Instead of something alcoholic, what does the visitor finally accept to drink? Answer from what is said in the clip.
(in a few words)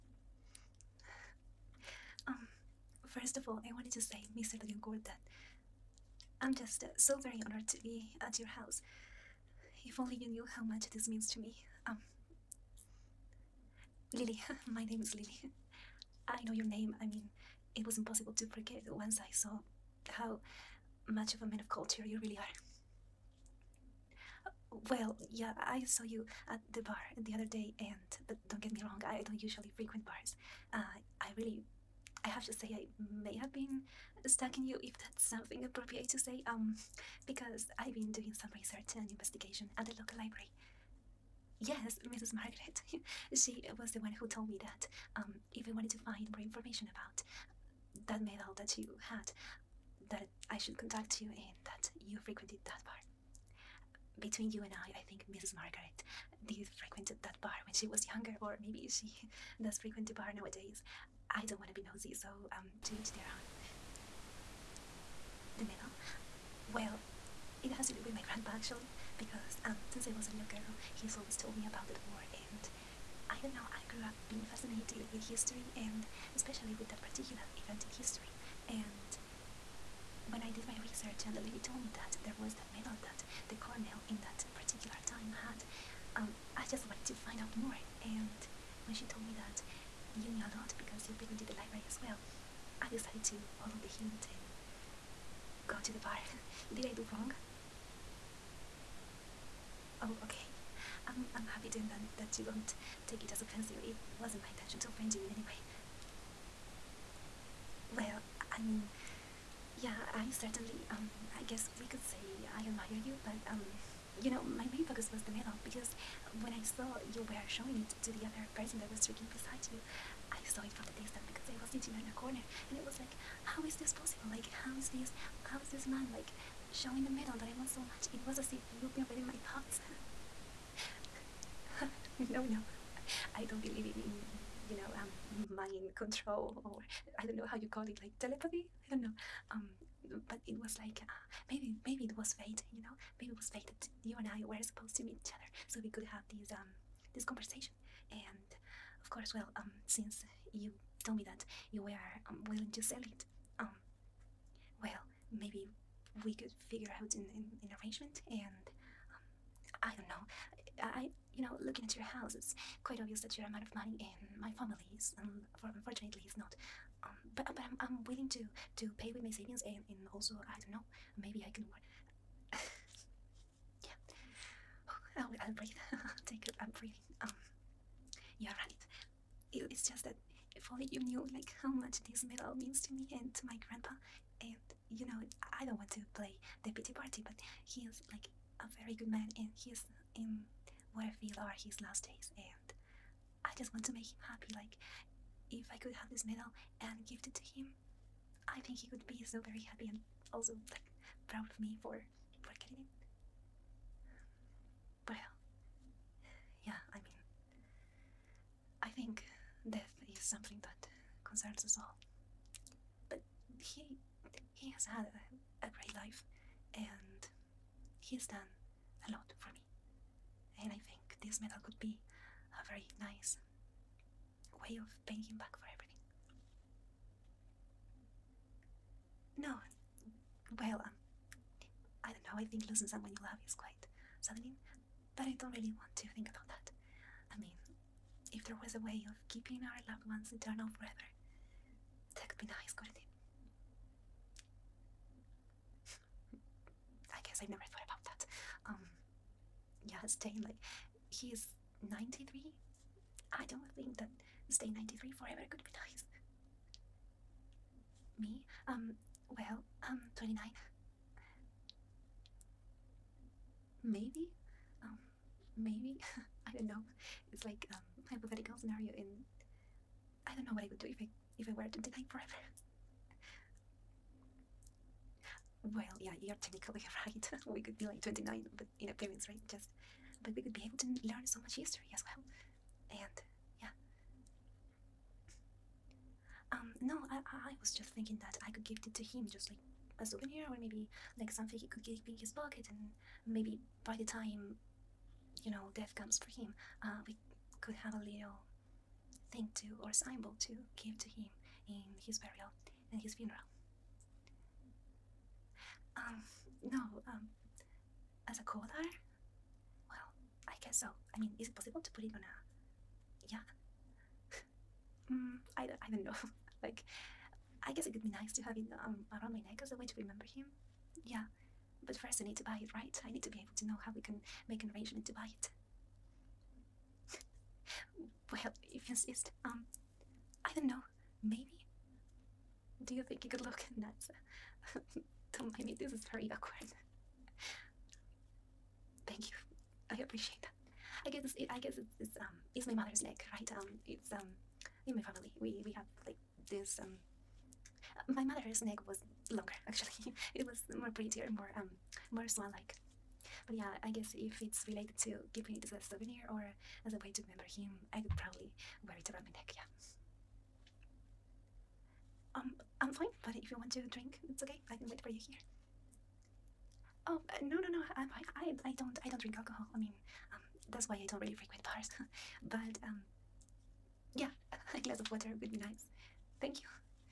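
a glass of water.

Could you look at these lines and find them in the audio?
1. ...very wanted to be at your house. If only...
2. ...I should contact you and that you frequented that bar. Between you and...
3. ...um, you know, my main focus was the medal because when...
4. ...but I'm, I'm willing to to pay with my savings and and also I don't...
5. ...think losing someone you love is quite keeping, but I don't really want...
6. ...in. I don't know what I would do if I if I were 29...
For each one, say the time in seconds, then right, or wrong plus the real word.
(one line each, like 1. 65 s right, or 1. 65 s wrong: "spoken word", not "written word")
1. 7 s wrong: "honored", not "wanted"
2. 50 s right
3. 113 s right
4. 167 s right
5. 232 s wrong: "saddening", not "keeping"
6. 268 s right.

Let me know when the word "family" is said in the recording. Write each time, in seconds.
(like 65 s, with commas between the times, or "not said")
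164 s, 345 s.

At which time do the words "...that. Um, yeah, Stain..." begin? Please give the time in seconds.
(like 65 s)
248 s.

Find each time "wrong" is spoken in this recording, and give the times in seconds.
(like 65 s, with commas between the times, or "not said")
28 s, 97 s.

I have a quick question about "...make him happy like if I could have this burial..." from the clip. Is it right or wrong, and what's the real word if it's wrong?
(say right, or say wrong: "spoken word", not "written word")
wrong: "medal", not "burial".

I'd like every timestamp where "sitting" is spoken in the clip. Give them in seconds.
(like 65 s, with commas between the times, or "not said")
121 s.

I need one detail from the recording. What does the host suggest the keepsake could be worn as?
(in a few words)
a collar.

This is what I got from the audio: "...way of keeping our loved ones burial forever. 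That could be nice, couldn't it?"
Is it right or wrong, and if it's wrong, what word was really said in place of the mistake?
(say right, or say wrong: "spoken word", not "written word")
wrong: "eternal", not "burial".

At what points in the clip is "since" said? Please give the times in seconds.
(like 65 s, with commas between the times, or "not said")
69 s, 149 s.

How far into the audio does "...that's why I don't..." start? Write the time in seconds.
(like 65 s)
370 s.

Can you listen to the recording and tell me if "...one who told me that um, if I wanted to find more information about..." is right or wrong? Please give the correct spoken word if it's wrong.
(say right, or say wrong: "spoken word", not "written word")
right.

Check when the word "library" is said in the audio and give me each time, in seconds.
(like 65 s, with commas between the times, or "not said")
40 s, 91 s.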